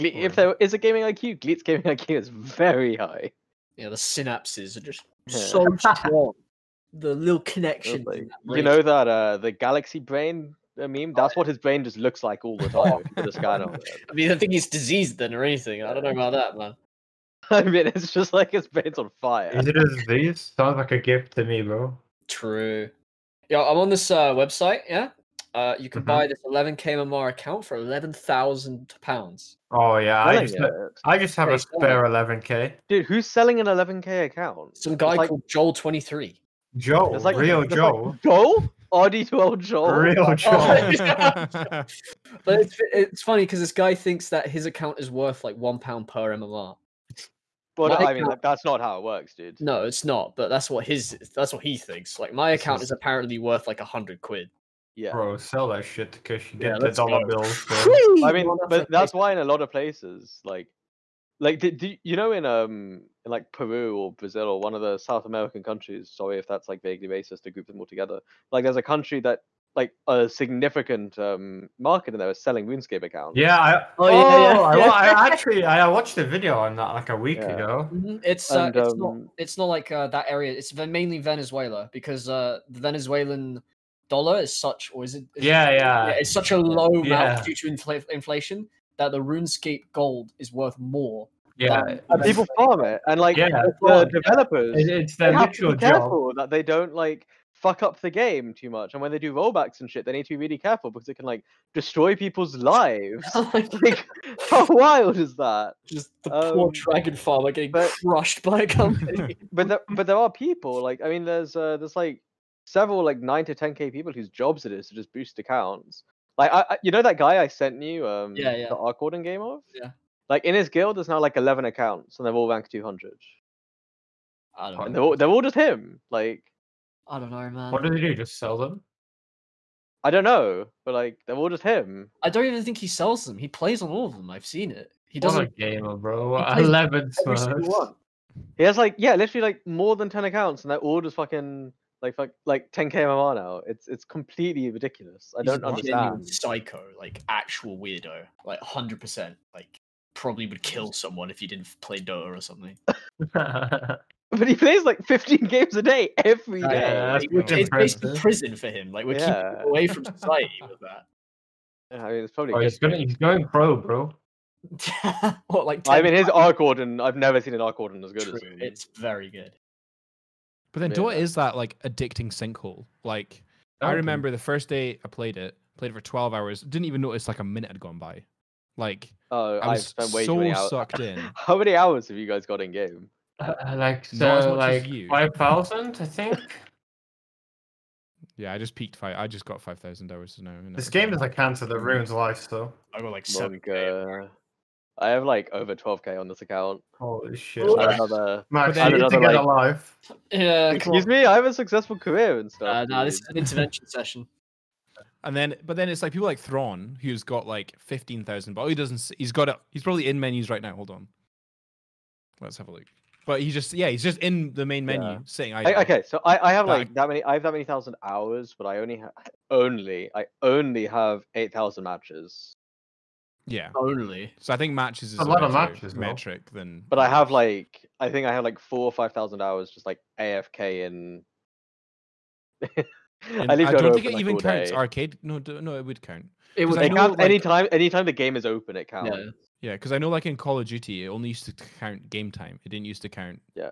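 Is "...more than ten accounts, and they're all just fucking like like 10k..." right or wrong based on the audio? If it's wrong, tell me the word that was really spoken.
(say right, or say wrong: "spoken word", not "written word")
right.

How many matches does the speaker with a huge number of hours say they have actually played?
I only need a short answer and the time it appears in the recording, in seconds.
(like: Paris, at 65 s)
8,000, at 221 s.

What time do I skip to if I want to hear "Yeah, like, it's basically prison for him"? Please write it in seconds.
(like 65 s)
156 s.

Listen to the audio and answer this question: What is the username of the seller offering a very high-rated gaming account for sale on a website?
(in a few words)
Joel 23.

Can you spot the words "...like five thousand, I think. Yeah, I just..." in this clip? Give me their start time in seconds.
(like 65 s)
184 s.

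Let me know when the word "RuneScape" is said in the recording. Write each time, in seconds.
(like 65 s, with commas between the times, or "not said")
72 s, 89 s.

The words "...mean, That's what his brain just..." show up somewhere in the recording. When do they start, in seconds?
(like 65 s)
10 s.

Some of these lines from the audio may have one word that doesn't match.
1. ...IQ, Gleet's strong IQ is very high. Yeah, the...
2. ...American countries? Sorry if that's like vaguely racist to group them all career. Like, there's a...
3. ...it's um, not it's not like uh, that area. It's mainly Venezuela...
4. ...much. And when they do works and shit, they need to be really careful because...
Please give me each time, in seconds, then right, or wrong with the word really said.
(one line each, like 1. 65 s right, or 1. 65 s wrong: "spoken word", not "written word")
1. 1 s wrong: "gaming", not "strong"
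2. 65 s wrong: "together", not "career"
3. 78 s right
4. 98 s wrong: "rollbacks", not "works".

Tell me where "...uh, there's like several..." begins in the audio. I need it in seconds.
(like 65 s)
111 s.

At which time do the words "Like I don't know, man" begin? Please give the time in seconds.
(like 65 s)
126 s.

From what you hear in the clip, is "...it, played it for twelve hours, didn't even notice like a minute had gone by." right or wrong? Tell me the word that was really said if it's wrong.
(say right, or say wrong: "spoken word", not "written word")
right.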